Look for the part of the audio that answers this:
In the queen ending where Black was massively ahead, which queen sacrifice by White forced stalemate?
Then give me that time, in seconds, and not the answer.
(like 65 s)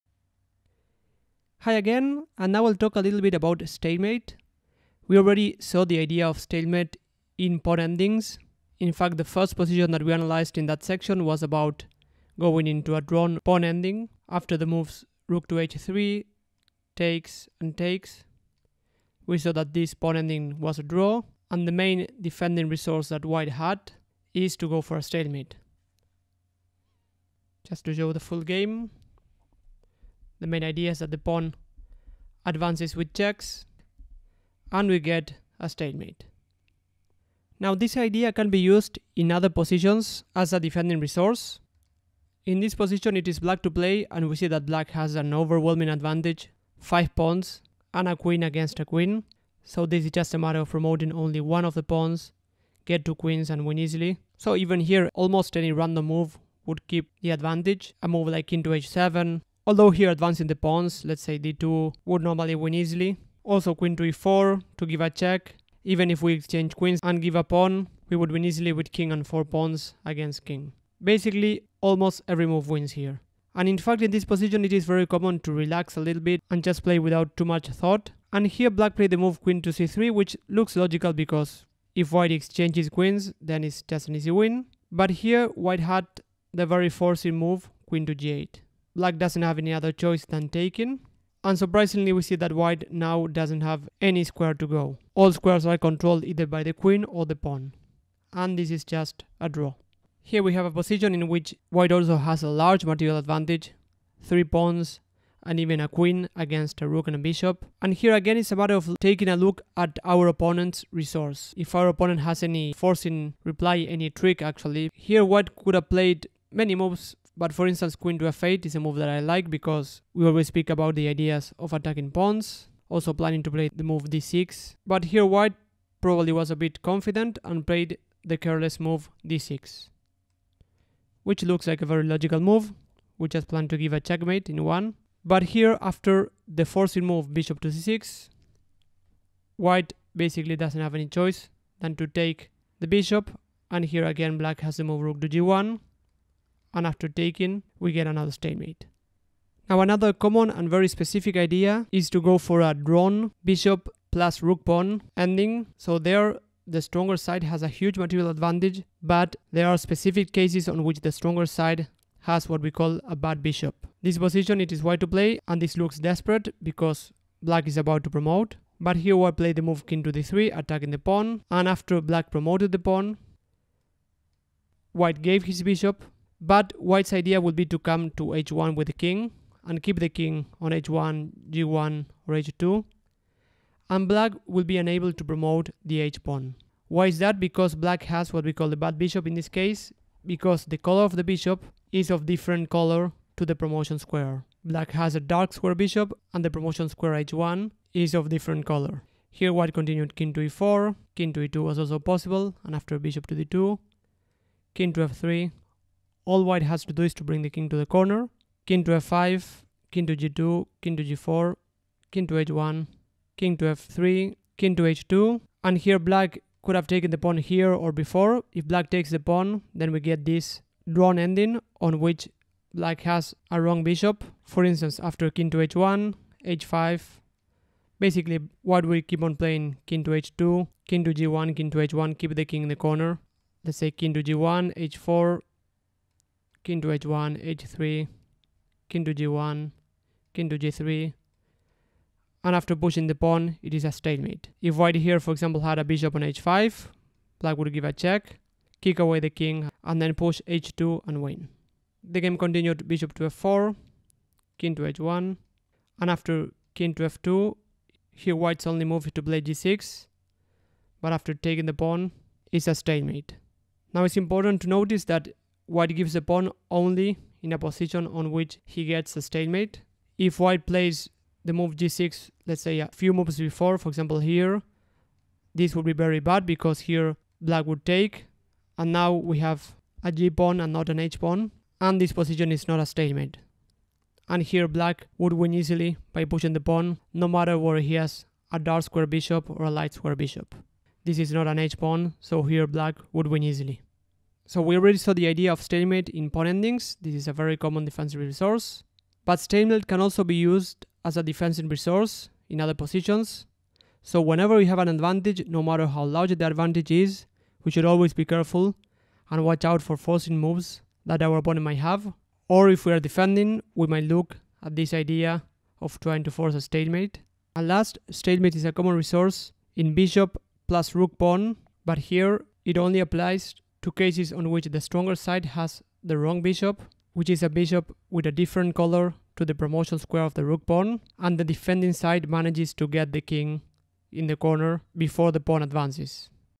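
87 s.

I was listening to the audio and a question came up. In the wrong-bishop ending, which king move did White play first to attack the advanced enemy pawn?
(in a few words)
King to d3.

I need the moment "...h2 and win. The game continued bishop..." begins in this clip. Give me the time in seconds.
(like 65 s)
250 s.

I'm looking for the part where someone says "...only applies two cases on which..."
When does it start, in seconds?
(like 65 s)
322 s.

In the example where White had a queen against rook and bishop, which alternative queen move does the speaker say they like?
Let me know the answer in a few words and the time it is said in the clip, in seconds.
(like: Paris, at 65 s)
Queen to f8, at 117 s.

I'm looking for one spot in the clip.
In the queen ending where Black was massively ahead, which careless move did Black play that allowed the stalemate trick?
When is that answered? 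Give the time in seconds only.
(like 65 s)
79 s.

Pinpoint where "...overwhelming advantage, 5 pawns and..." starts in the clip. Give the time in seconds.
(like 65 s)
45 s.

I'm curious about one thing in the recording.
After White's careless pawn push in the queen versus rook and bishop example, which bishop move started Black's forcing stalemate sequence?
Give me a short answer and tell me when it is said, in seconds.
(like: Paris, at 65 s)
Bishop to c6, at 137 s.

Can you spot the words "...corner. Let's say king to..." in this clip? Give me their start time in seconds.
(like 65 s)
232 s.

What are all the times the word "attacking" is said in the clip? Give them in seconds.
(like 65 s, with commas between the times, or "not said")
121 s, 170 s.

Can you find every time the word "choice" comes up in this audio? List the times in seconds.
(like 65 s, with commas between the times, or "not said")
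89 s, 141 s.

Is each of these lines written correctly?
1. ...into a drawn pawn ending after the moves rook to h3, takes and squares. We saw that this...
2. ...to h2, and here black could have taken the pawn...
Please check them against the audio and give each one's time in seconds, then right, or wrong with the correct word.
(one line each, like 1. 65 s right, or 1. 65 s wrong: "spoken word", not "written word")
1. 12 s wrong: "takes", not "squares"
2. 214 s right.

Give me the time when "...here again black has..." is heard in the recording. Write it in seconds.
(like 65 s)
143 s.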